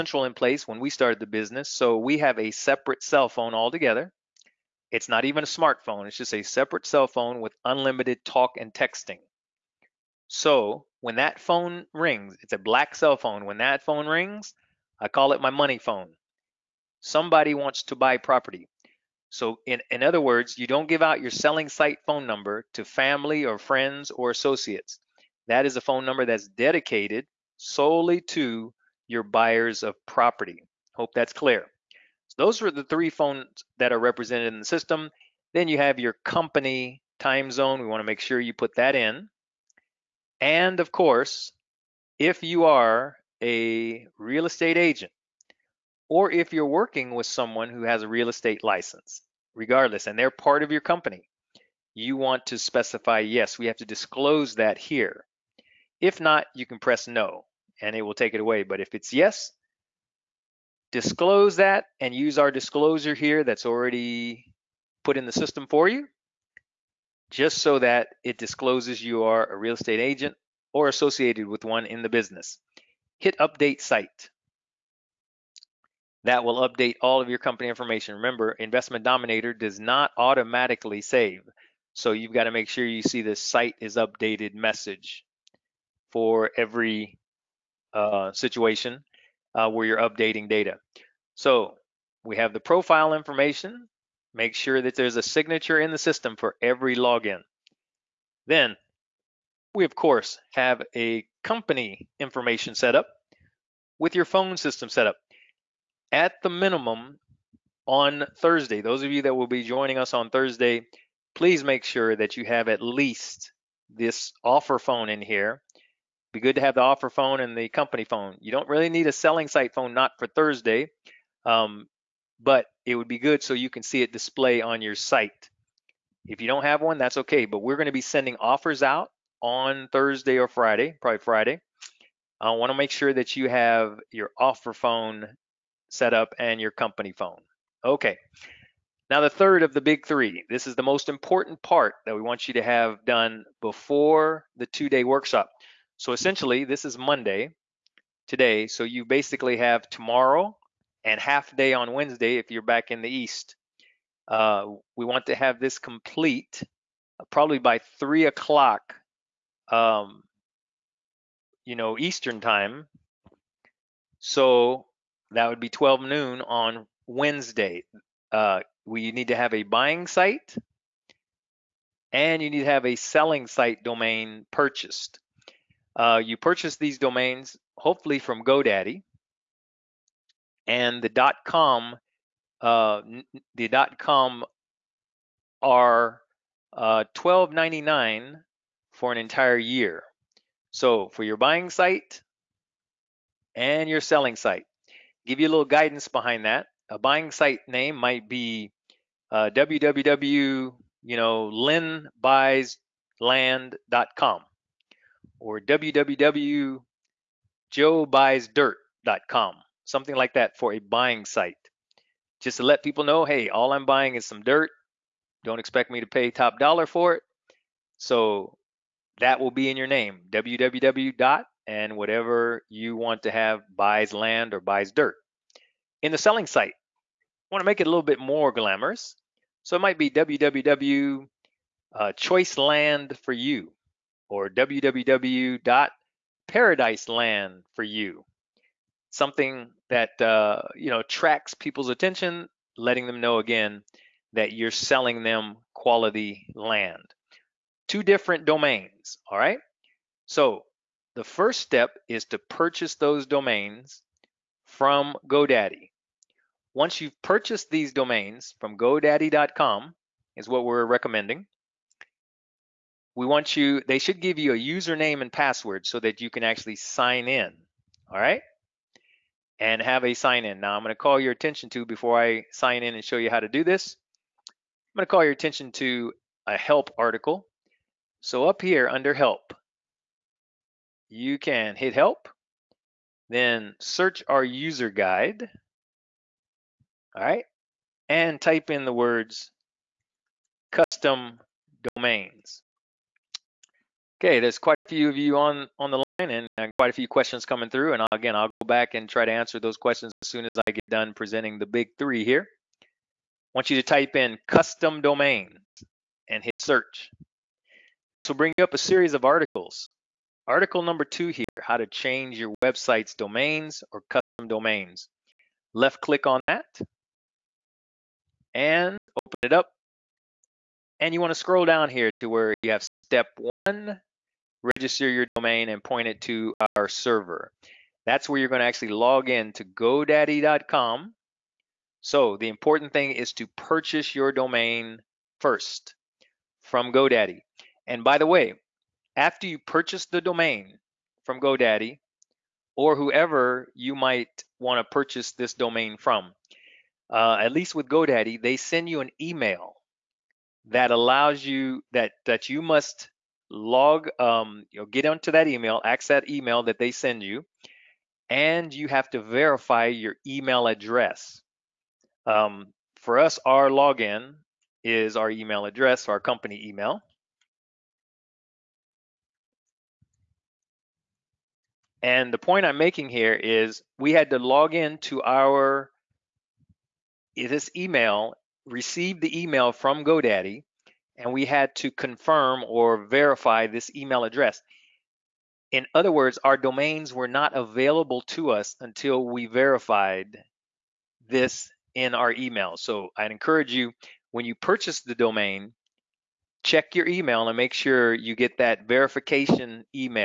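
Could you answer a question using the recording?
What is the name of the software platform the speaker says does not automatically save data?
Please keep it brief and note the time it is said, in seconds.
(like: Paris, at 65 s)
Investment Dominator, at 78 s.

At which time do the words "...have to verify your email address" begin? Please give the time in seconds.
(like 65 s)
358 s.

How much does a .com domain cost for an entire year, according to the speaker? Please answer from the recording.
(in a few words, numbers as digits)
$12.99.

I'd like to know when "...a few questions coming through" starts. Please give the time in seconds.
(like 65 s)
296 s.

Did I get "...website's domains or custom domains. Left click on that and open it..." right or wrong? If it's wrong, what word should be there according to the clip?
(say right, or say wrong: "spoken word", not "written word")
right.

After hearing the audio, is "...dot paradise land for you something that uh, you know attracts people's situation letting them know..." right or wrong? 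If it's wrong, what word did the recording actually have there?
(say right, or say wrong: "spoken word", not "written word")
wrong: "attention", not "situation".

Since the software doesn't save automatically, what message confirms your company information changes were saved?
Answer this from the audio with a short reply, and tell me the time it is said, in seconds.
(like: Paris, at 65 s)
site is updated, at 83 s.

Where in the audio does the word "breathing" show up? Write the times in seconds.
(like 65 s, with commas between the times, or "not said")
not said.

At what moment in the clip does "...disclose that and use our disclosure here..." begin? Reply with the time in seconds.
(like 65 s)
60 s.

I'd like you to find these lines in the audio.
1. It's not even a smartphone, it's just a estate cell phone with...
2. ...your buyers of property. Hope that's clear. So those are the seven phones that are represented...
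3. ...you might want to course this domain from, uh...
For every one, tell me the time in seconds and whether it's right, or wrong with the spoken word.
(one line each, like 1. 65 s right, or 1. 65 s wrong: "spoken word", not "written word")
1. 4 s wrong: "separate", not "estate"
2. 29 s wrong: "three", not "seven"
3. 343 s wrong: "purchase", not "course".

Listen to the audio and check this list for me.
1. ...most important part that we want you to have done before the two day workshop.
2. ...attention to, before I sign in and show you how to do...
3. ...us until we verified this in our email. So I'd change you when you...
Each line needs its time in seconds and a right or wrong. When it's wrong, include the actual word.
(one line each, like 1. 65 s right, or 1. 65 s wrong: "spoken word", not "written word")
1. 140 s right
2. 271 s right
3. 388 s wrong: "encourage", not "change".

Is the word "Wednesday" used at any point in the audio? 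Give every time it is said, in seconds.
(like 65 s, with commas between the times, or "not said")
151 s, 167 s.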